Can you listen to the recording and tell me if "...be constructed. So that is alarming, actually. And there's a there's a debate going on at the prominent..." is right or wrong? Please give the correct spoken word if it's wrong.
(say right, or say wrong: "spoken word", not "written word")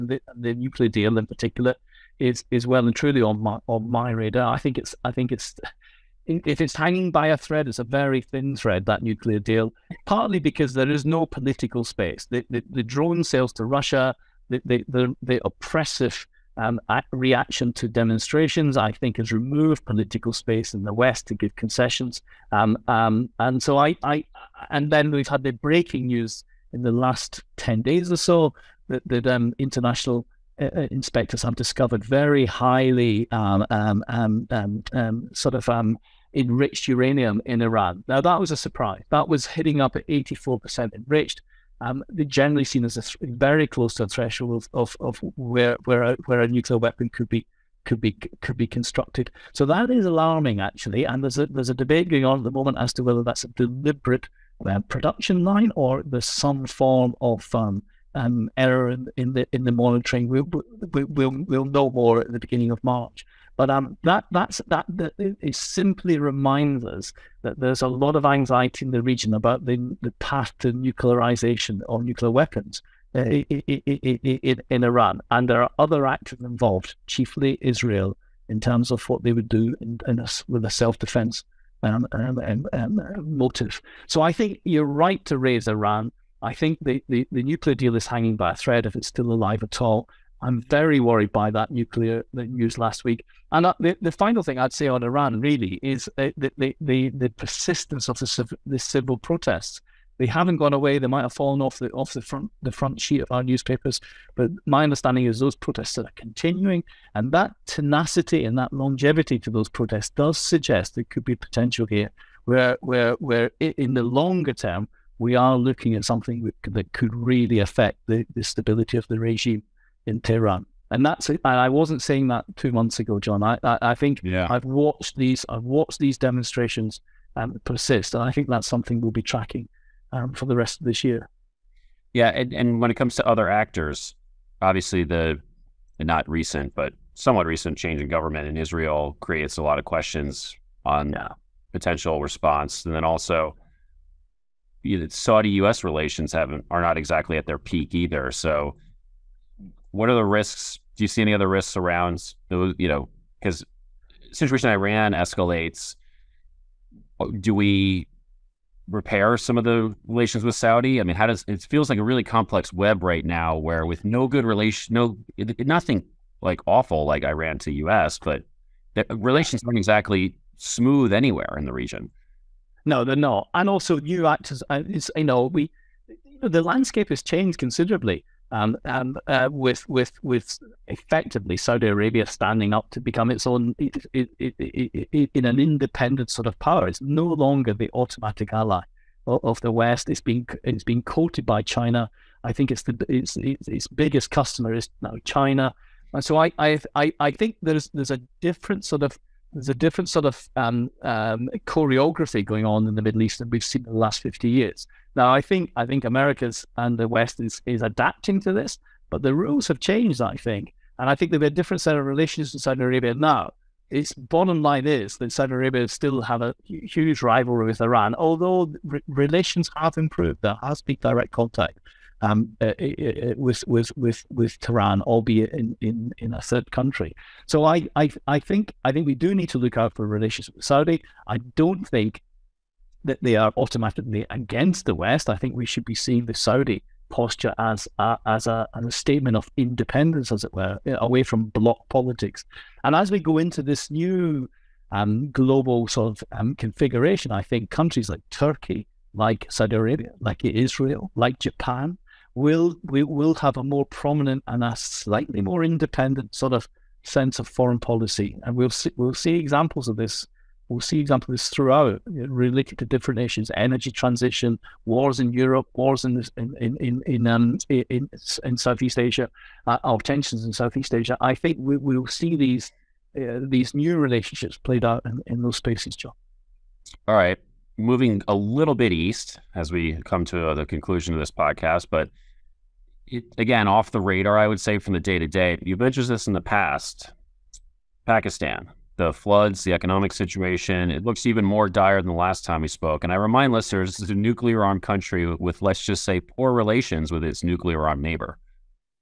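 wrong: "moment", not "prominent".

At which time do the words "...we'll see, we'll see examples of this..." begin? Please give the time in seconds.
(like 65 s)
258 s.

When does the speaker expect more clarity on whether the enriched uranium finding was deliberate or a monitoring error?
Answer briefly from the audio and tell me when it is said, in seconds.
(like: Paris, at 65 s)
beginning of March, at 62 s.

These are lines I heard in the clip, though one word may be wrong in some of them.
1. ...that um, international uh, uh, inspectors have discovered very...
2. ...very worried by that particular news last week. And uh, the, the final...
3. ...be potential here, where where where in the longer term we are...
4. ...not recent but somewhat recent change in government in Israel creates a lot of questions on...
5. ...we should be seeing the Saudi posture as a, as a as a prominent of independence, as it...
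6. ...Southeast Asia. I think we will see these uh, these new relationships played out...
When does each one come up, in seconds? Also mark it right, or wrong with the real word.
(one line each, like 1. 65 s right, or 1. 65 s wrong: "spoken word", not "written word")
1. 29 s right
2. 90 s wrong: "nuclear", not "particular"
3. 111 s right
4. 135 s right
5. 235 s wrong: "statement", not "prominent"
6. 270 s right.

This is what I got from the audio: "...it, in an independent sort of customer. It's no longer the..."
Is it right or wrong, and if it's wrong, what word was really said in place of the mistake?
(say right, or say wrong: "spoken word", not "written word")
wrong: "power", not "customer".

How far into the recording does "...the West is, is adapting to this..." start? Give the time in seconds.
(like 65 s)
206 s.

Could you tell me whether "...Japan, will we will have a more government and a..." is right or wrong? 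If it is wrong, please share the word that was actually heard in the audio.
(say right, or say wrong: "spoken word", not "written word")
wrong: "prominent", not "government".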